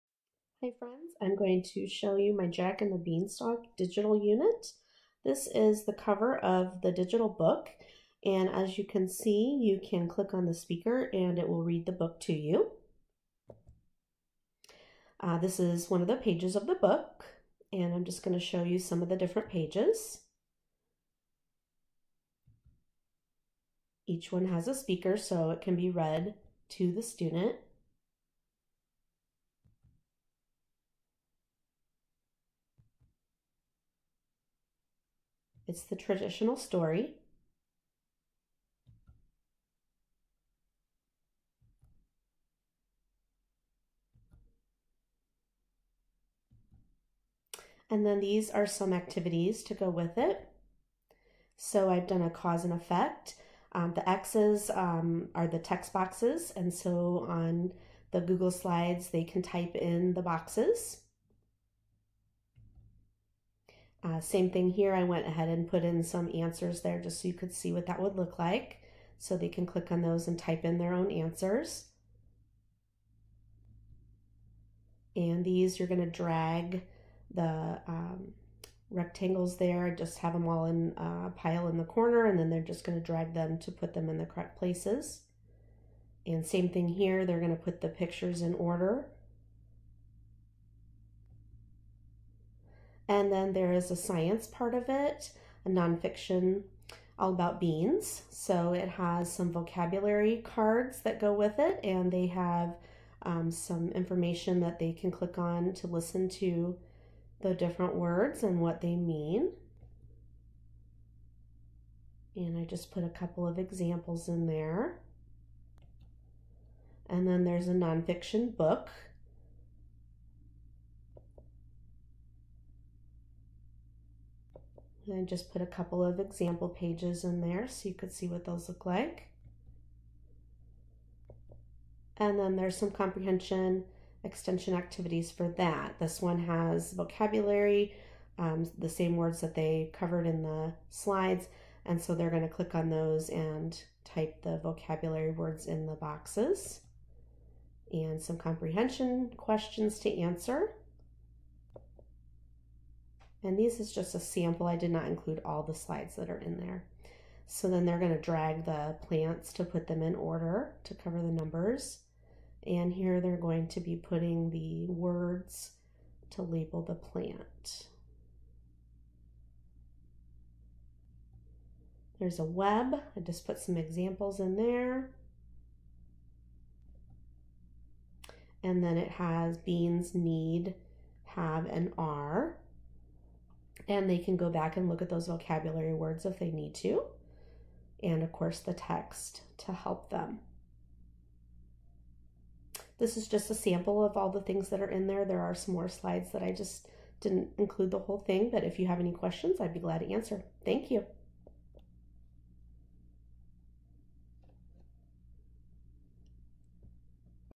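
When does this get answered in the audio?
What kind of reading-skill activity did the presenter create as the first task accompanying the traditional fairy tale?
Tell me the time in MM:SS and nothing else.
00:52.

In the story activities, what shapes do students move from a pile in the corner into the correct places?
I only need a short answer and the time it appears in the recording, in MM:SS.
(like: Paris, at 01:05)
Rectangles, at 01:18.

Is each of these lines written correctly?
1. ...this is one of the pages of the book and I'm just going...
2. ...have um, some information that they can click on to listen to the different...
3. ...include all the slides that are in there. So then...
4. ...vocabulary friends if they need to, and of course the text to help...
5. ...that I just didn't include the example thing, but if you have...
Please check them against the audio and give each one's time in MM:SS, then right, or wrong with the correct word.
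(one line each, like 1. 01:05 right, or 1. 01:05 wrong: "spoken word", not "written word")
1. 00:15 right
2. 01:42 right
3. 02:35 right
4. 03:05 wrong: "words", not "friends"
5. 03:16 wrong: "whole", not "example".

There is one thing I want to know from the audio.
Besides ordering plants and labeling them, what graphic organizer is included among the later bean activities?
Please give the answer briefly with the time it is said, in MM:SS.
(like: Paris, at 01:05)
A web, at 02:52.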